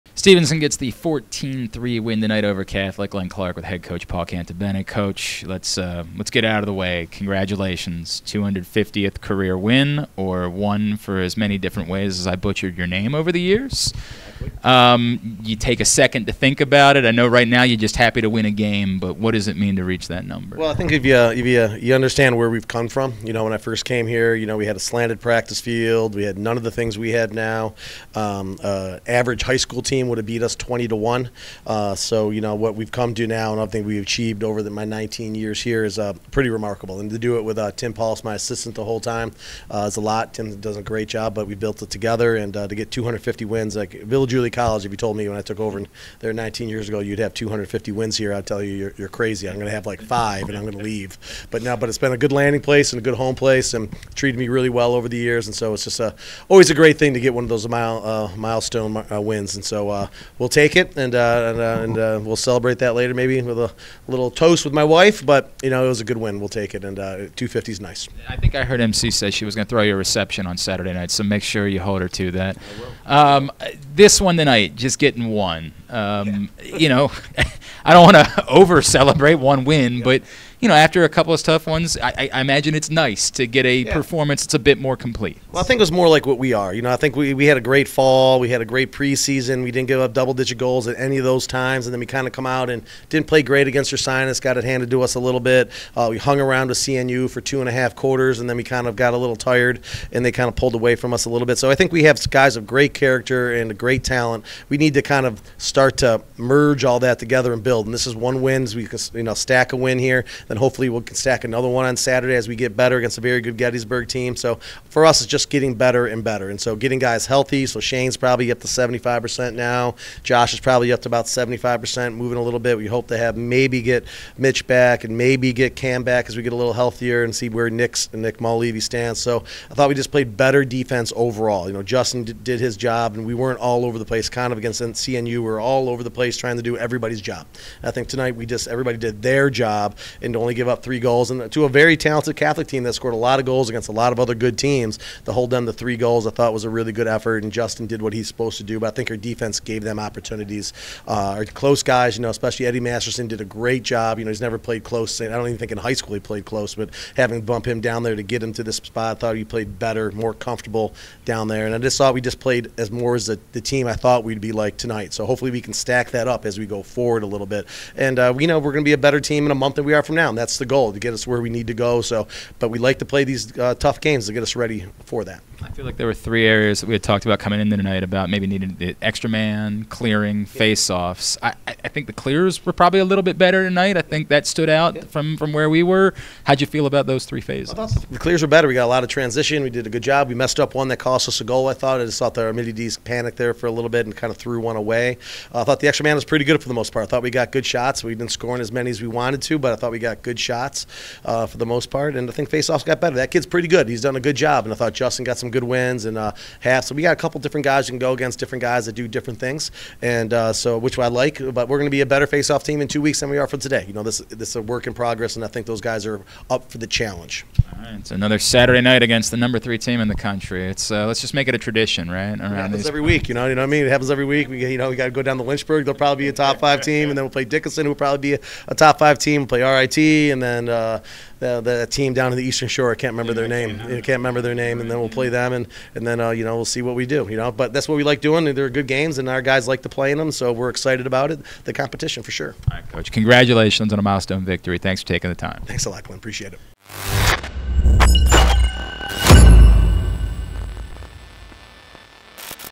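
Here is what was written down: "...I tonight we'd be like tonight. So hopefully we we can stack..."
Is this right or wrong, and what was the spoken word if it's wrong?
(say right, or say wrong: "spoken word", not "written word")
wrong: "thought", not "tonight".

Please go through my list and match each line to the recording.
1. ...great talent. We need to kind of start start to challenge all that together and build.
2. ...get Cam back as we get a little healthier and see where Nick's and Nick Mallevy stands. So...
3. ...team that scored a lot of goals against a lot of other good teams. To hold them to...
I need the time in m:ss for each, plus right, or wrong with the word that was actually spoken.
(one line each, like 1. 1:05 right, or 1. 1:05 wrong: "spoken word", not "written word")
1. 1:43 wrong: "merge", not "challenge"
2. 2:05 right
3. 2:22 right.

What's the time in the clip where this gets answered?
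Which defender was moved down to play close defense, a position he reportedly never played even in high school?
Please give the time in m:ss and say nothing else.
2:32.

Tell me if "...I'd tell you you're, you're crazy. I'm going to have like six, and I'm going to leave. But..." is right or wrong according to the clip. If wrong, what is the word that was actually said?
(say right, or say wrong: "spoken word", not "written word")
wrong: "five", not "six".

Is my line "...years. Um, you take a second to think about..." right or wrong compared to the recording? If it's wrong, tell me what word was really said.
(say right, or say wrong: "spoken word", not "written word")
right.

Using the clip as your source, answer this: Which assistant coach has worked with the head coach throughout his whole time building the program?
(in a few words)
Tim Pauls.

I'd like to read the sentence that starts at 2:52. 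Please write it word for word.
So, but we like to play these uh, tough games to get us ready for that.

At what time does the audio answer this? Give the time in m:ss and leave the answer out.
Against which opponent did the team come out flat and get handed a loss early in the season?
1:33.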